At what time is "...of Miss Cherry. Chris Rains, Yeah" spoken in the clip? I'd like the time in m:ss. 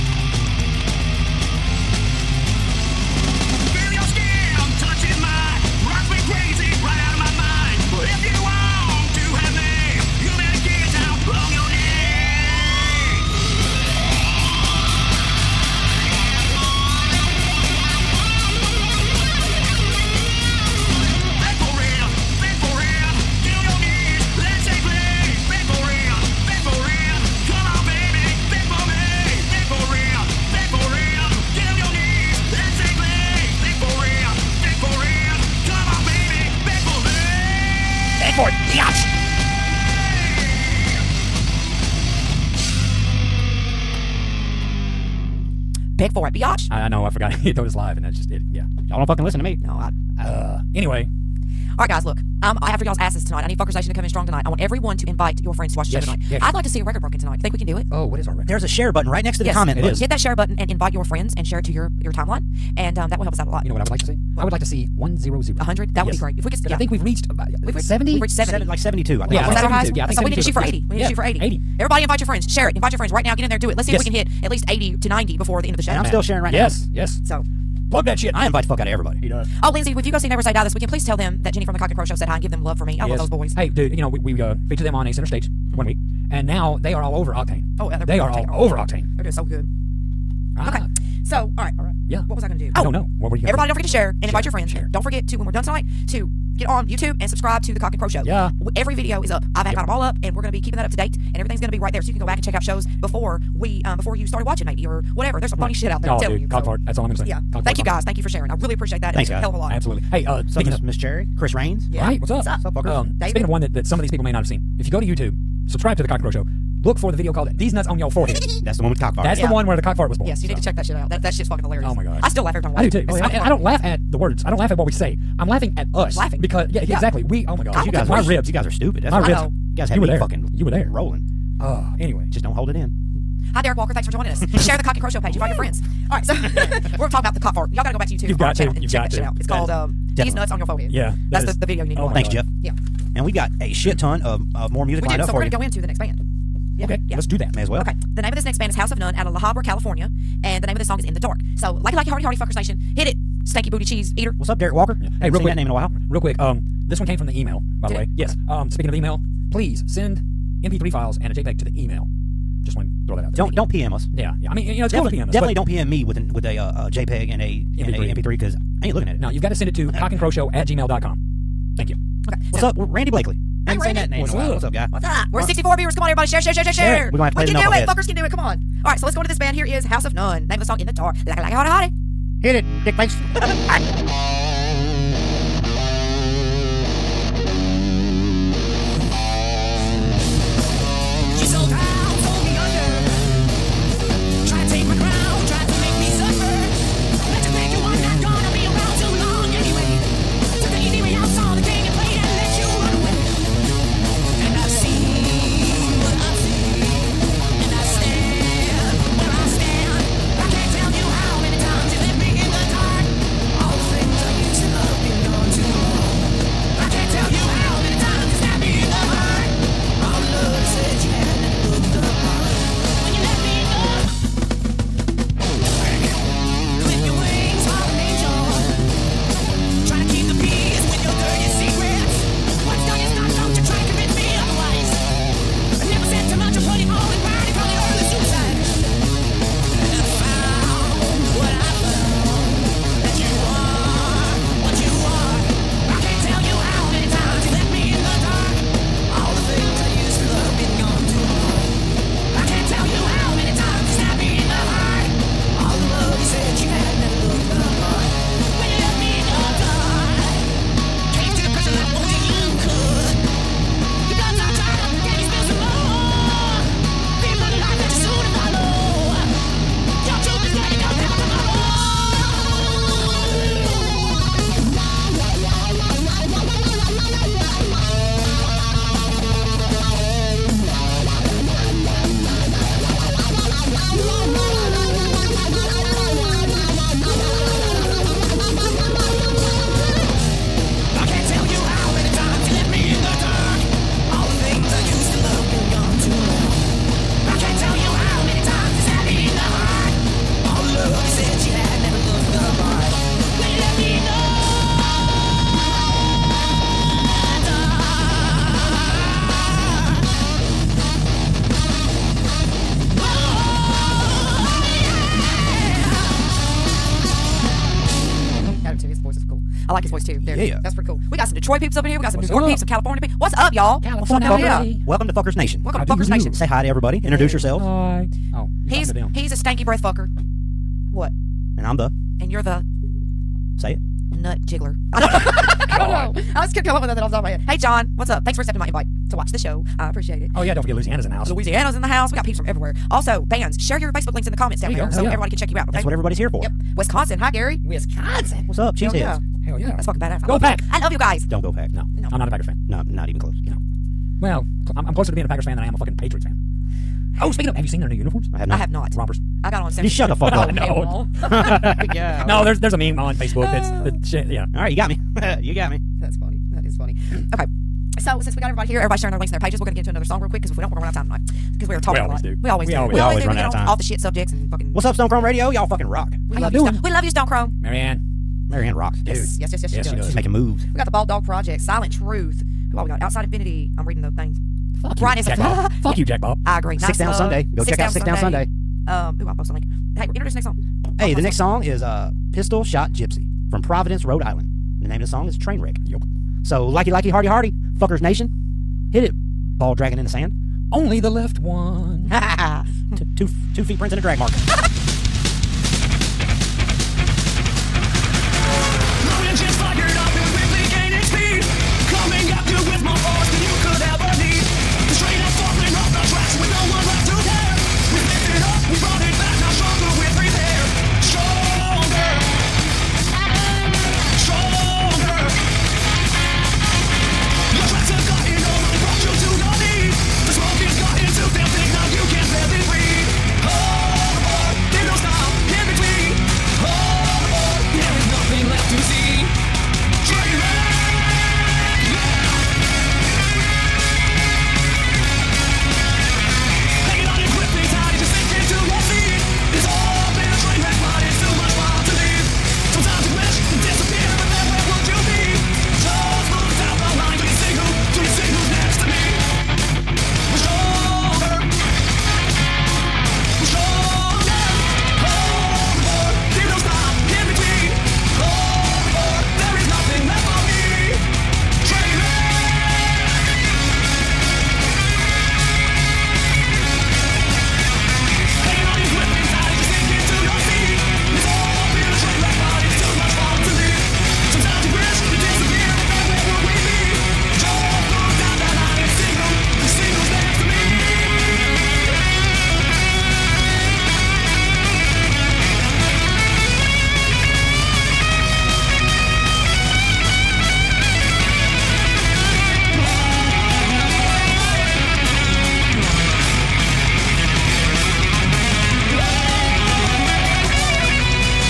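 1:50.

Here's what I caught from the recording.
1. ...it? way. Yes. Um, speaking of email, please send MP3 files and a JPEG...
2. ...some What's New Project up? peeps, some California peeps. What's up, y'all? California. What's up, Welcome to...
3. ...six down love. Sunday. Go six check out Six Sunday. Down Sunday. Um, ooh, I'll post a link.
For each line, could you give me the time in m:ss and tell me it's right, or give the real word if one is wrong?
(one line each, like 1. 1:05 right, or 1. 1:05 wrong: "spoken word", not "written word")
1. 2:37 right
2. 5:22 wrong: "York", not "Project"
3. 6:26 right.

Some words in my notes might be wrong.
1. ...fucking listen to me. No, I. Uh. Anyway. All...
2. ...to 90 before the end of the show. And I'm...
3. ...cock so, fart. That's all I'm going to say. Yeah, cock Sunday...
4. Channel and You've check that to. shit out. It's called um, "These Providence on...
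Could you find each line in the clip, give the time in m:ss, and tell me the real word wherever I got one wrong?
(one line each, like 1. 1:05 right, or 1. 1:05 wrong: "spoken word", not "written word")
1. 0:49 right
2. 1:15 right
3. 1:46 wrong: "Thank", not "Sunday"
4. 2:18 wrong: "Nuts", not "Providence".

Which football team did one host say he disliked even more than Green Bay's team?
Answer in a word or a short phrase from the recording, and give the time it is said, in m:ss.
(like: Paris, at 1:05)
Patriots, at 5:55.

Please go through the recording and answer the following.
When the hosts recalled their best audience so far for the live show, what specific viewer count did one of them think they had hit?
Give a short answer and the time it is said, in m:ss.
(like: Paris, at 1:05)
72, at 1:08.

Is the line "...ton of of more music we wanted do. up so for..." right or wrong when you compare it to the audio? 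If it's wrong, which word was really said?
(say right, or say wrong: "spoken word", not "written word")
wrong: "lined", not "wanted".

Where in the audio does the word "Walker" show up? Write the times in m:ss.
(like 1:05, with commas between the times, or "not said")
2:13, 2:34.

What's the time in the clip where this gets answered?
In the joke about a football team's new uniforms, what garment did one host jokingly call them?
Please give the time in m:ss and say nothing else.
5:58.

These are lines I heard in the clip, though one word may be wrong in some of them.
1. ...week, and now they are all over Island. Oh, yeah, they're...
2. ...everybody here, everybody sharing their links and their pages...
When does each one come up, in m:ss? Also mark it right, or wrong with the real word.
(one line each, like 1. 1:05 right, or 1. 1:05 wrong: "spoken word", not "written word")
1. 1:25 wrong: "Octane", not "Island"
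2. 6:08 right.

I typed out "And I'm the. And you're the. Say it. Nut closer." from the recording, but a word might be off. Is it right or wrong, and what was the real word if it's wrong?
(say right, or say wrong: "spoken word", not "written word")
wrong: "jiggler", not "closer".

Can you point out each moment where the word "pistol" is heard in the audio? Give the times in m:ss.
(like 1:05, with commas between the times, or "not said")
6:32.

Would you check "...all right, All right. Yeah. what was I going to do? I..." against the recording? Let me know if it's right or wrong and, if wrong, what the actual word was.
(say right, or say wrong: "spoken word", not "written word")
right.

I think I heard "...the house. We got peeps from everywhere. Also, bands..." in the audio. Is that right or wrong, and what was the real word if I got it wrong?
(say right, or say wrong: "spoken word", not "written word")
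right.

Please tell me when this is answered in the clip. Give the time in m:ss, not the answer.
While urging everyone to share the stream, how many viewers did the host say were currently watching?
2:55.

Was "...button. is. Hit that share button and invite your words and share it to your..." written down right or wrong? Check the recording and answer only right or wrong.
wrong.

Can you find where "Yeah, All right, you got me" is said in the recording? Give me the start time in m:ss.
6:04.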